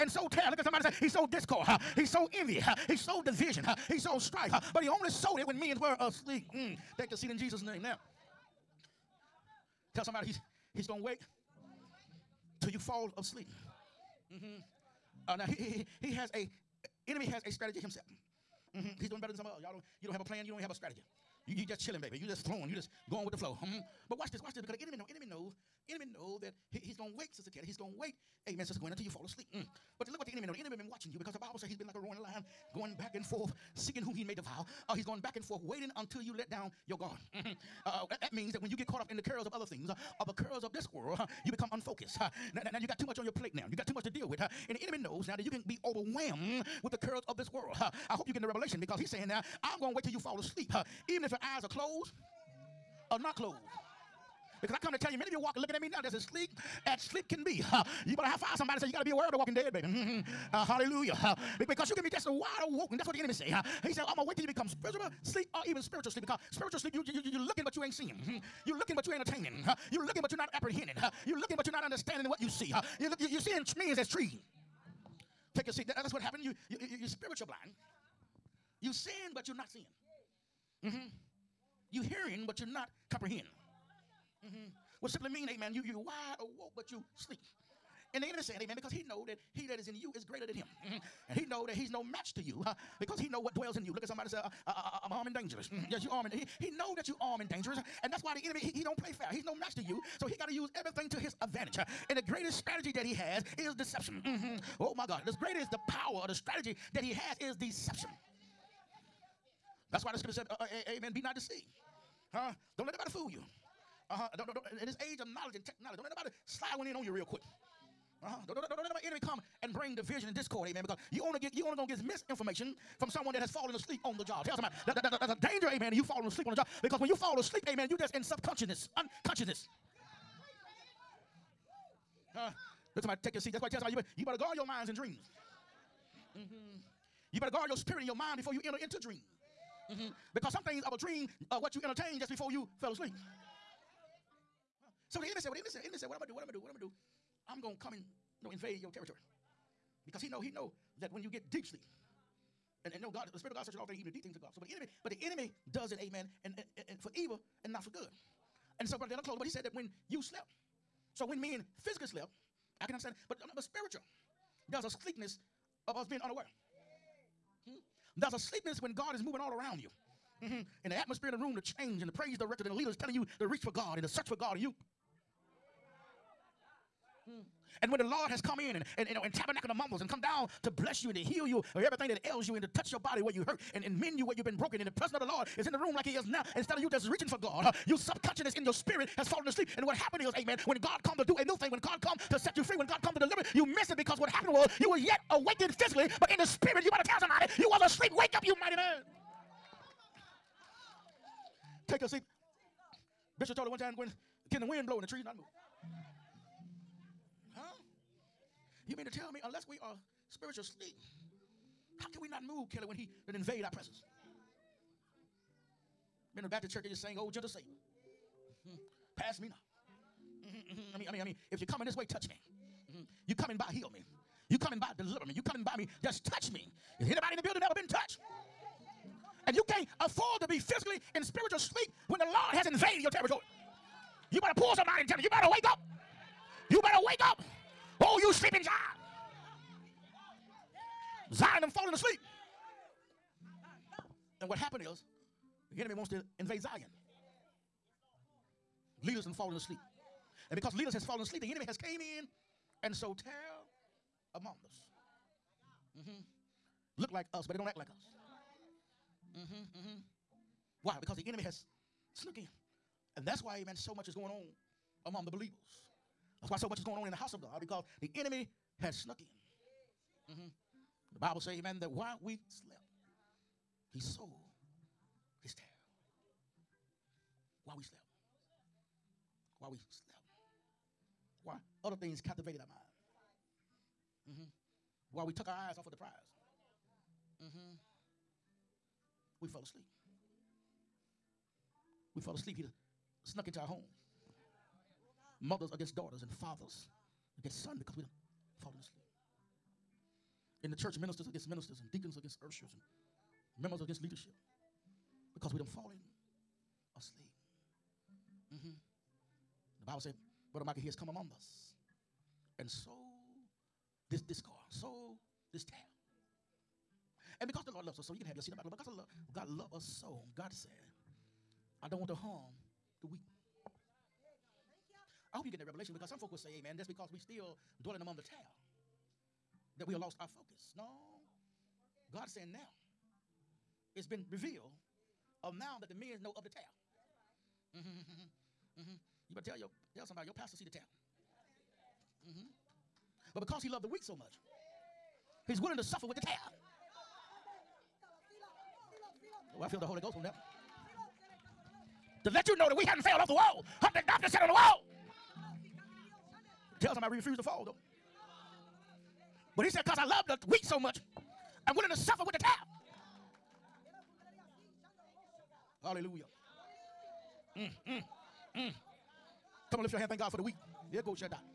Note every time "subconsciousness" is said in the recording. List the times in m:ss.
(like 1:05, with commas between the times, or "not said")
2:08, 3:07.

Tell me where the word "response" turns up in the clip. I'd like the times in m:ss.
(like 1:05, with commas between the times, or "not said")
not said.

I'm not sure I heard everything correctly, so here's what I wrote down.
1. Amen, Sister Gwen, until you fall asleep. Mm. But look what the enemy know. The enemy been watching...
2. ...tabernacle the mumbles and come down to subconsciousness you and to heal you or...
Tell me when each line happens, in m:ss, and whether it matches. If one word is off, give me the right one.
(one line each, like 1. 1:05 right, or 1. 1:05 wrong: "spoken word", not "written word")
1. 0:28 right
2. 2:59 wrong: "bless", not "subconsciousness".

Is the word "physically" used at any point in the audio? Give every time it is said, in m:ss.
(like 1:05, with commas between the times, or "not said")
2:41, 3:15, 3:50.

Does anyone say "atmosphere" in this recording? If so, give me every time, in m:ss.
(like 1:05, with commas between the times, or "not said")
2:50.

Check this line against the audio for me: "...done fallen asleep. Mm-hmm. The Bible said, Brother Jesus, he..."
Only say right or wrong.
wrong.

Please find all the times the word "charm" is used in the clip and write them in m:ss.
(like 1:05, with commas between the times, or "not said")
not said.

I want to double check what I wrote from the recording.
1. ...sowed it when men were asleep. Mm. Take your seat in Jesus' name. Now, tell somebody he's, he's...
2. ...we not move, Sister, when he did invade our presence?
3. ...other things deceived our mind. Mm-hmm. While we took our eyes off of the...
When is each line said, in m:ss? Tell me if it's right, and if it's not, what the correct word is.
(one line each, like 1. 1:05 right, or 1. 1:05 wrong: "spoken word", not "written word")
1. 0:05 right
2. 3:32 wrong: "Kelly", not "Sister"
3. 4:41 wrong: "captivated", not "deceived".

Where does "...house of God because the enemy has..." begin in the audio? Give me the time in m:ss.
4:27.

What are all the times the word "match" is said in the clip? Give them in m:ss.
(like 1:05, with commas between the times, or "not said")
1:32, 1:39.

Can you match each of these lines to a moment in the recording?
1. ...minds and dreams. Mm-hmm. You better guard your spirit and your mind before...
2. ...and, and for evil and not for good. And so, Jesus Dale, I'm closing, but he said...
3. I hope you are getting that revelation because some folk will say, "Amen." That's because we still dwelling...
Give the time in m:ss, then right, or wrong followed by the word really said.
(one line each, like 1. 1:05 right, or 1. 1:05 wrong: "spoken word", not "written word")
1. 2:14 right
2. 2:36 wrong: "Brother", not "Jesus"
3. 5:25 right.